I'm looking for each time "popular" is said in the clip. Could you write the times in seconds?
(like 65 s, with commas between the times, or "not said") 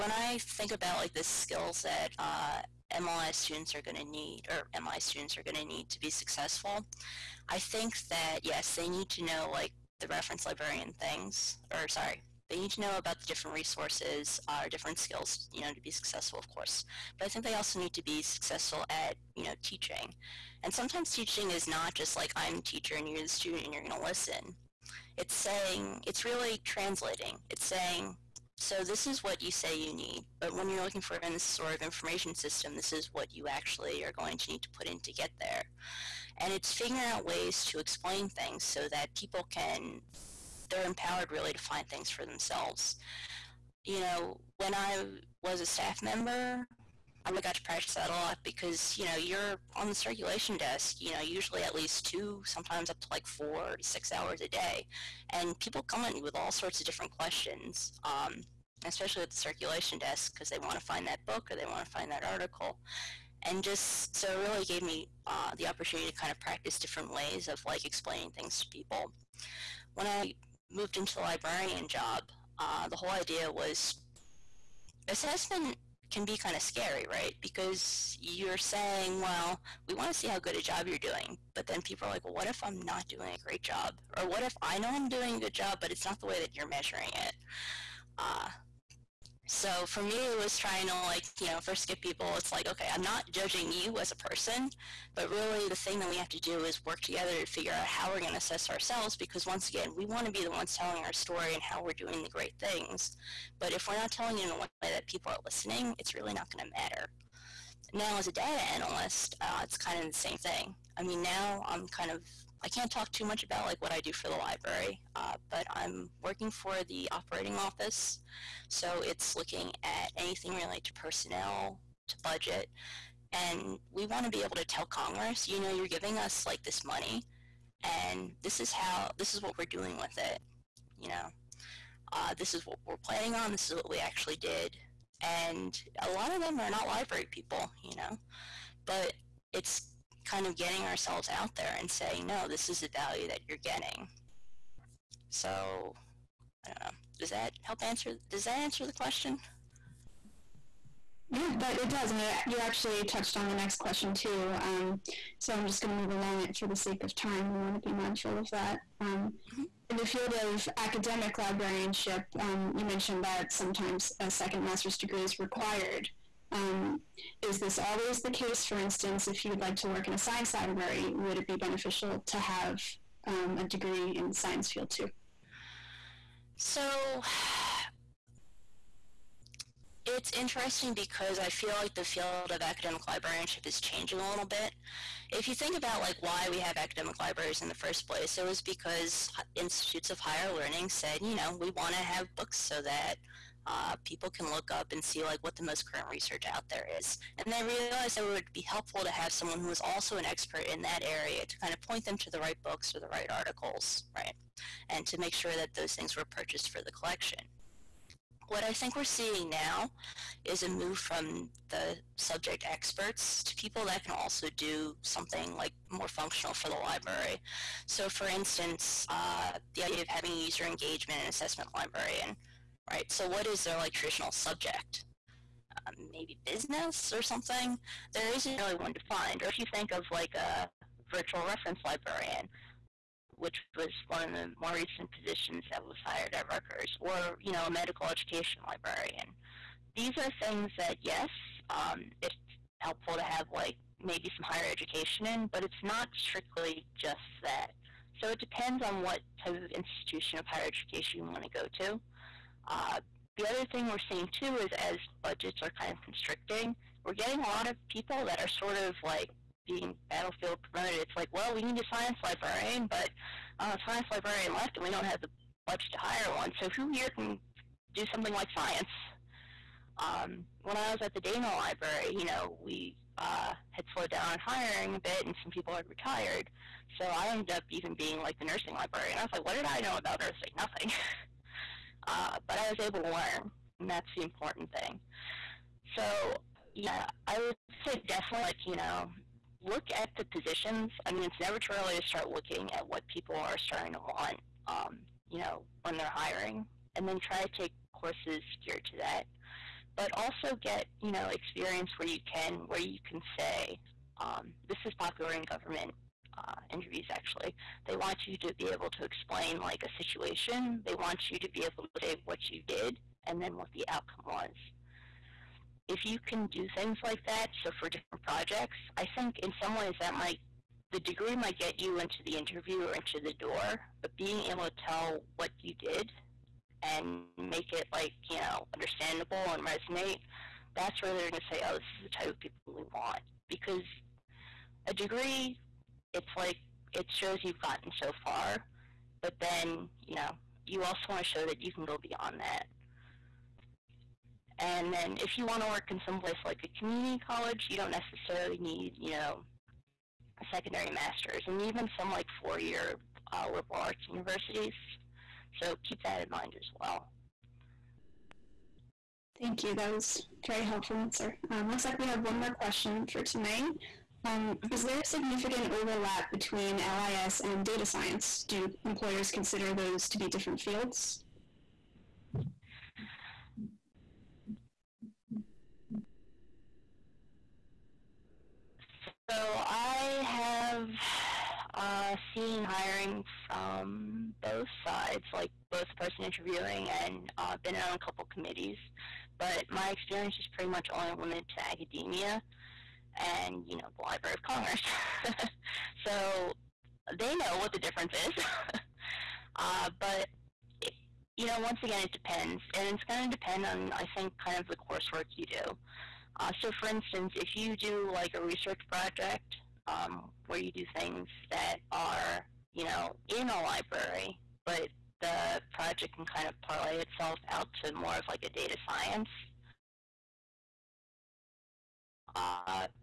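304 s.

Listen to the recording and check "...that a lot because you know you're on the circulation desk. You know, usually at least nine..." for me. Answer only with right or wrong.
wrong.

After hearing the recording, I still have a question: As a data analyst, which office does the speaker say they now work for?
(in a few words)
Operating office.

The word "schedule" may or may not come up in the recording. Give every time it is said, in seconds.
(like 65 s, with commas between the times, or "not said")
not said.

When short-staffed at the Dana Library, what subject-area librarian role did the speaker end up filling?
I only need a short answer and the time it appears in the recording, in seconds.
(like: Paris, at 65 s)
Nursing librarian, at 278 s.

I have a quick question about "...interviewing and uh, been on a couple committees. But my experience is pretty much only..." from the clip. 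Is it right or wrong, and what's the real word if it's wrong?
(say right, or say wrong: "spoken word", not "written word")
right.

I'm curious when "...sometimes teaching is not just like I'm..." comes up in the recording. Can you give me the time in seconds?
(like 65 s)
20 s.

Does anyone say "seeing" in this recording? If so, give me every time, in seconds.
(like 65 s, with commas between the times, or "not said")
209 s, 254 s.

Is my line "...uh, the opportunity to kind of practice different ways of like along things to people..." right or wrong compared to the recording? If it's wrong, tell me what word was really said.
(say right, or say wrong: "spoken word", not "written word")
wrong: "explaining", not "along".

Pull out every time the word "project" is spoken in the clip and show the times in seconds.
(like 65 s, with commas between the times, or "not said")
318 s, 408 s, 415 s.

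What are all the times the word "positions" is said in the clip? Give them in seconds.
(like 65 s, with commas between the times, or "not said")
235 s, 290 s.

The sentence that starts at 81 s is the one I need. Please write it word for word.
But then people are like, well, what if I'm not doing a great job?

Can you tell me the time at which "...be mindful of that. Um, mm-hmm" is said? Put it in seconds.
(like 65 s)
157 s.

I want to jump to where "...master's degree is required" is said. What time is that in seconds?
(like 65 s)
164 s.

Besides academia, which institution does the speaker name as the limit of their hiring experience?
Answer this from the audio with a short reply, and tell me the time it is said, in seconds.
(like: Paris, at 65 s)
Library of Congress, at 394 s.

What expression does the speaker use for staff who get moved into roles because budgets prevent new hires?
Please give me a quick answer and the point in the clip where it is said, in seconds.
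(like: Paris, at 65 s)
Battlefield promoted, at 260 s.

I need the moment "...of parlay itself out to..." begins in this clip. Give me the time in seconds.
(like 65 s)
416 s.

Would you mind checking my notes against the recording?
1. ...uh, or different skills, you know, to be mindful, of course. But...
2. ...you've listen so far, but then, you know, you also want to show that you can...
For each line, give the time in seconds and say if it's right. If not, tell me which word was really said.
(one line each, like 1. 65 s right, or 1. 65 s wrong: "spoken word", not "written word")
1. 14 s wrong: "successful", not "mindful"
2. 337 s wrong: "gotten", not "listen".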